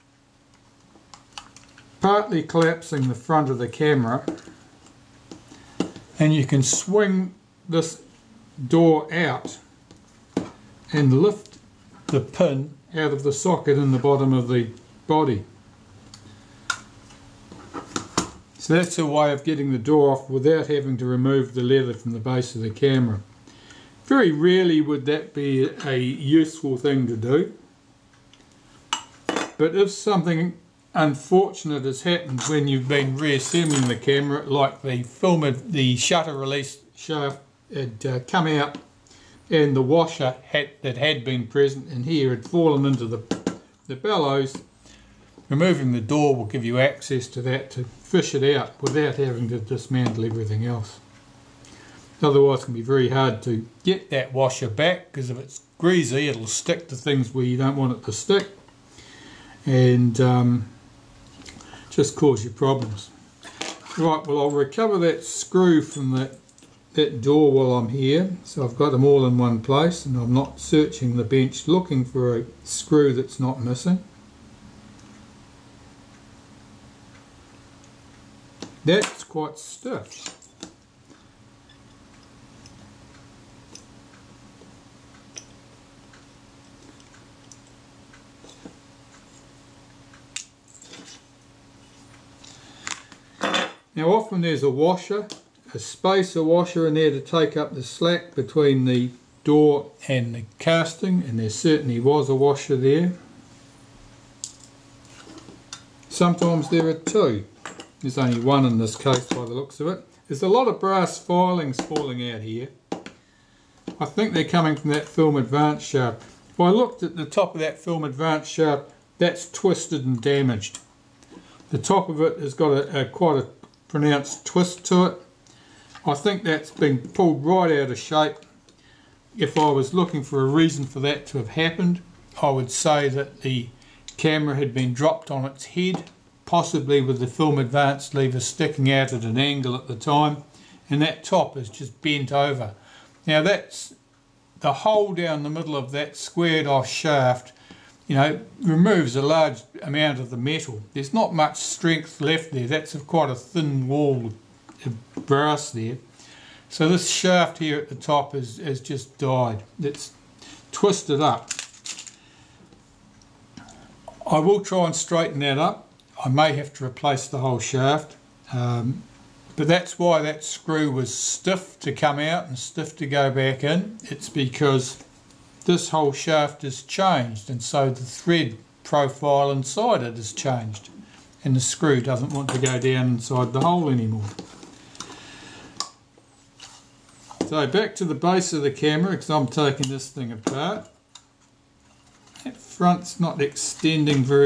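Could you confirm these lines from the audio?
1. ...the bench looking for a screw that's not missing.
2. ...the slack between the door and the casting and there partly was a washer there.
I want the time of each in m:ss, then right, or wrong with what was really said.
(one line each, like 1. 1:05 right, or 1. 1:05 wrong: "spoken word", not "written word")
1. 1:11 right
2. 1:37 wrong: "certainly", not "partly".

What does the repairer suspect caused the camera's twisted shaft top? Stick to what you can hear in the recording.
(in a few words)
Dropped on its head.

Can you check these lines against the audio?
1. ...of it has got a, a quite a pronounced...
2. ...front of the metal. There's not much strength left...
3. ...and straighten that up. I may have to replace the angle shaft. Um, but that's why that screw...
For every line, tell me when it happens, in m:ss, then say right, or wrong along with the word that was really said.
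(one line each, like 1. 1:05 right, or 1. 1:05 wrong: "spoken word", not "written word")
1. 2:02 right
2. 2:29 wrong: "amount", not "front"
3. 2:44 wrong: "whole", not "angle".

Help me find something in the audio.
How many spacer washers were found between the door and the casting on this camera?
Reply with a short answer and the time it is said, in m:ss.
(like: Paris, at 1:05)
1, at 1:48.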